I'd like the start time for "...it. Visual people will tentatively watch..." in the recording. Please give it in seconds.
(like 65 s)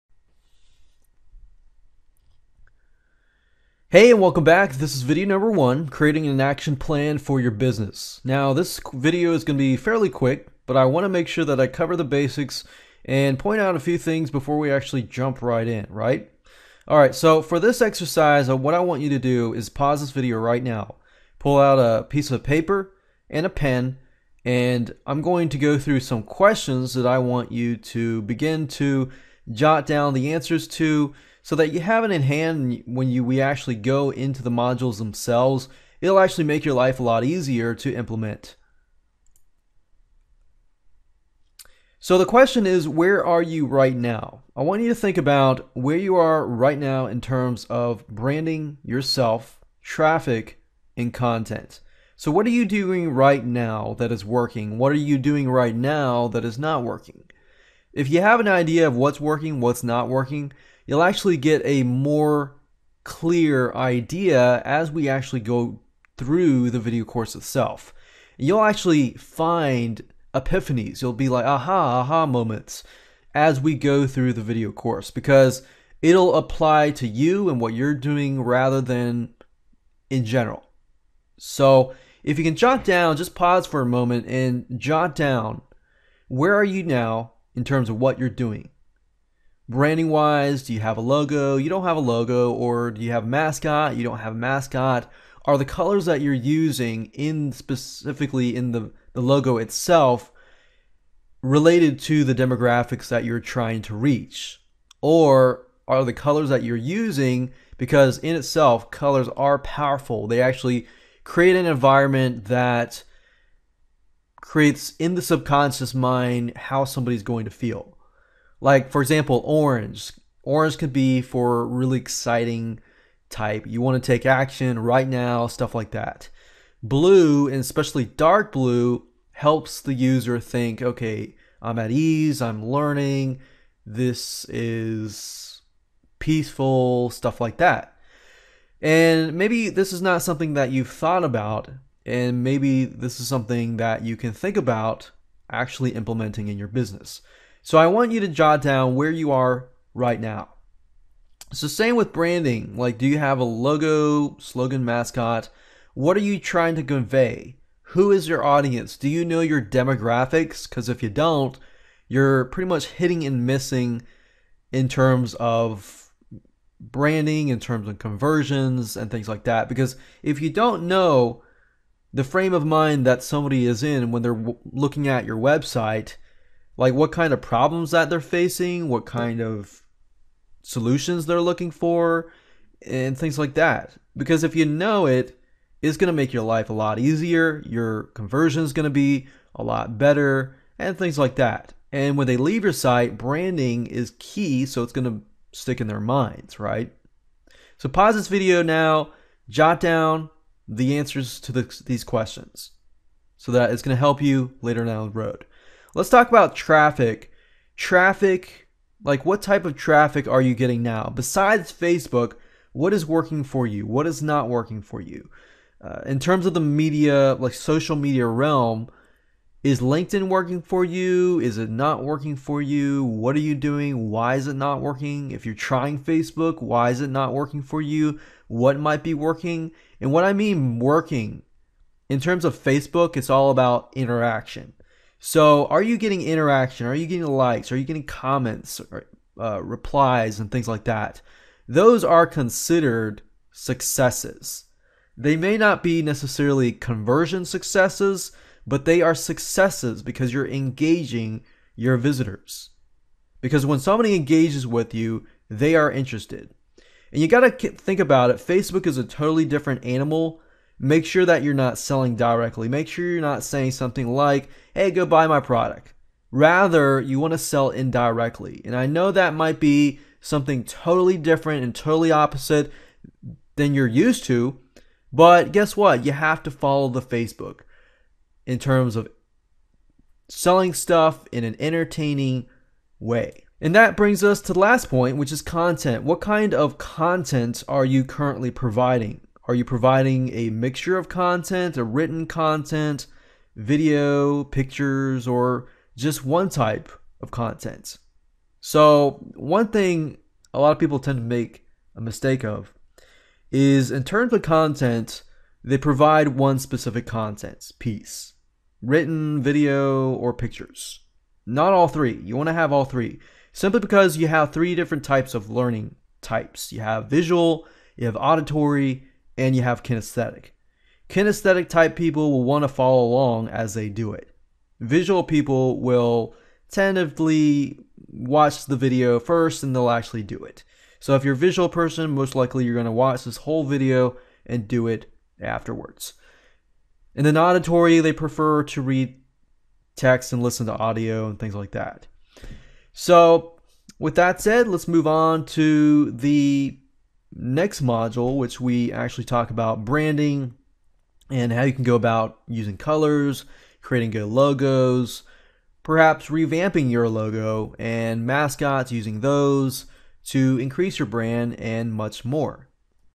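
324 s.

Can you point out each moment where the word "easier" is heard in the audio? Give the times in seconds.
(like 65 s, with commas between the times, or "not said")
37 s, 186 s.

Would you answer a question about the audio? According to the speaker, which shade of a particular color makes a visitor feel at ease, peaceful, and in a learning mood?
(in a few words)
Dark blue.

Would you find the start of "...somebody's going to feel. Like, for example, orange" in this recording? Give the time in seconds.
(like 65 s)
116 s.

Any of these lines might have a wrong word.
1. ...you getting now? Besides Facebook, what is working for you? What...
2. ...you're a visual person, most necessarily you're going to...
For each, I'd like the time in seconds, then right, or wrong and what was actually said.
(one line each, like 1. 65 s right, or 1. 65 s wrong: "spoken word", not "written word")
1. 210 s right
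2. 331 s wrong: "likely", not "necessarily".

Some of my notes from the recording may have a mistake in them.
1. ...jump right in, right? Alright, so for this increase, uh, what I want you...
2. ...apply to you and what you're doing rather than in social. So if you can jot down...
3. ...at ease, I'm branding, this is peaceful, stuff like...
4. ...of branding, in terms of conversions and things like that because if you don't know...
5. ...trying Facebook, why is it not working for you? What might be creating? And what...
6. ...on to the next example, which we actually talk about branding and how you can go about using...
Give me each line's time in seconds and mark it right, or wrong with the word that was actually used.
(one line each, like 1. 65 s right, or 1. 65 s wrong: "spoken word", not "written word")
1. 15 s wrong: "exercise", not "increase"
2. 76 s wrong: "general", not "social"
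3. 131 s wrong: "learning", not "branding"
4. 165 s right
5. 225 s wrong: "working", not "creating"
6. 345 s wrong: "module", not "example".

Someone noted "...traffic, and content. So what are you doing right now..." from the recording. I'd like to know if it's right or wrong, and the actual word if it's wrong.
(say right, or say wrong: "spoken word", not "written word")
right.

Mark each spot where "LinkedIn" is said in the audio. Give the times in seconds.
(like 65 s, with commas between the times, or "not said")
219 s.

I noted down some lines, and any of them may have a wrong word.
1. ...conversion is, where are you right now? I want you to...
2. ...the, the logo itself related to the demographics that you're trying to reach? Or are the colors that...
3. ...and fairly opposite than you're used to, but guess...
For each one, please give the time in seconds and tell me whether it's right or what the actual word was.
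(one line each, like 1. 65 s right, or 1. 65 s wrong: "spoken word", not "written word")
1. 42 s wrong: "question", not "conversion"
2. 98 s right
3. 271 s wrong: "totally", not "fairly".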